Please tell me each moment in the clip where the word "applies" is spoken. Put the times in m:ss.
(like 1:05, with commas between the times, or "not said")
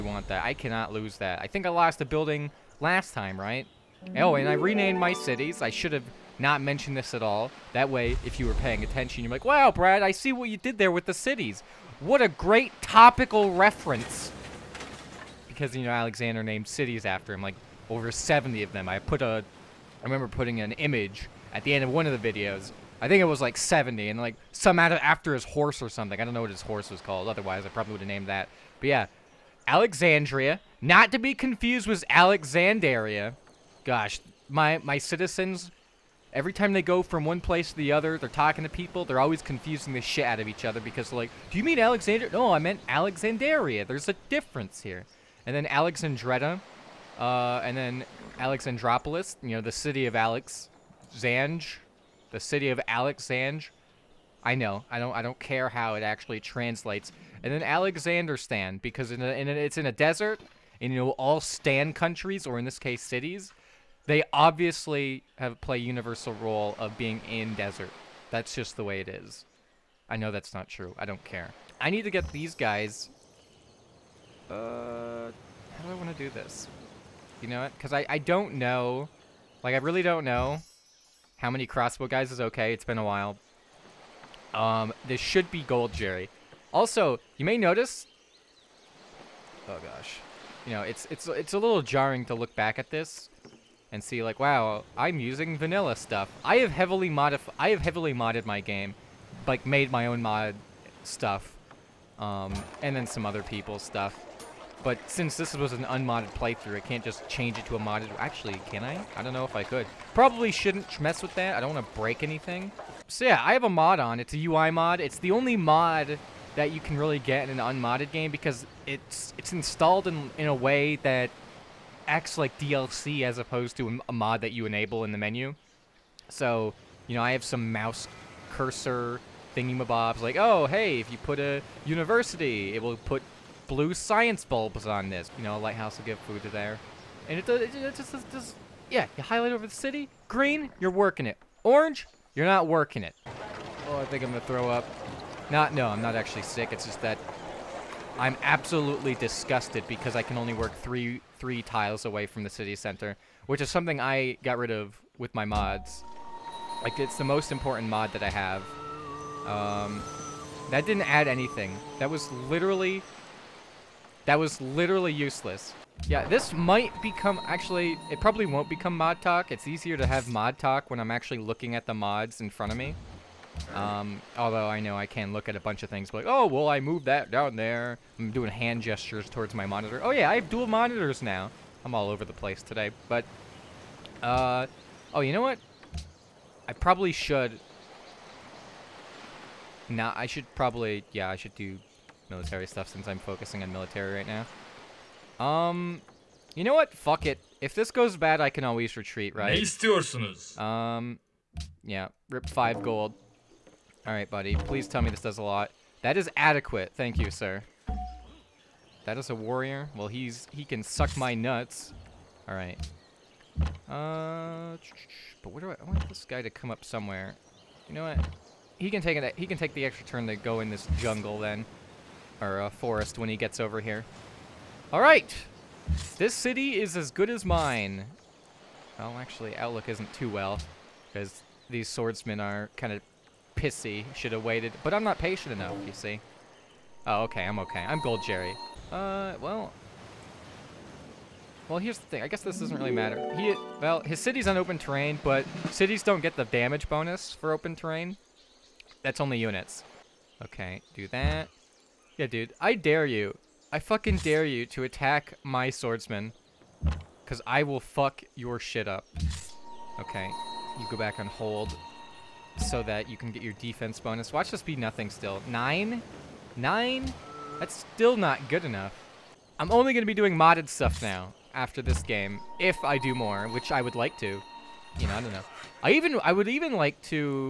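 not said.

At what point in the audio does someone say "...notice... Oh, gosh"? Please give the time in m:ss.
1:27.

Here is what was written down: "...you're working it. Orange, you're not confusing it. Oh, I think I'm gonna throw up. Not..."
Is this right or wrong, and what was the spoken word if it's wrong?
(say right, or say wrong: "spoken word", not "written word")
wrong: "working", not "confusing".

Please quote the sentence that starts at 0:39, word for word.
They're always confusing the shit out of each other because like, do you mean Alexandria?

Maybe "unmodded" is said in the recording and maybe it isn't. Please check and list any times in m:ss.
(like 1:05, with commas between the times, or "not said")
1:45, 1:57.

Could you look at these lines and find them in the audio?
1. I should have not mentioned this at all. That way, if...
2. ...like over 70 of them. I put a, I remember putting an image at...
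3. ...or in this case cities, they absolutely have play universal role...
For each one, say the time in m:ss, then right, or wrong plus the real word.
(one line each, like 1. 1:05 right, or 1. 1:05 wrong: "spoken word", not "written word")
1. 0:05 right
2. 0:17 right
3. 1:02 wrong: "obviously", not "absolutely".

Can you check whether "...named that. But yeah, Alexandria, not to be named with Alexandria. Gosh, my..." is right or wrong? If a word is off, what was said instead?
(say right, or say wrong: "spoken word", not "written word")
wrong: "confused", not "named".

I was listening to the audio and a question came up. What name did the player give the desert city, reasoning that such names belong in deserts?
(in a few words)
Alexanderstan.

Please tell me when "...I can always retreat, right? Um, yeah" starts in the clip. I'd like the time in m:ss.
3:18.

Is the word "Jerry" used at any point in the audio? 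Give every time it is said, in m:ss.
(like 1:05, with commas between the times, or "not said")
1:25, 3:58.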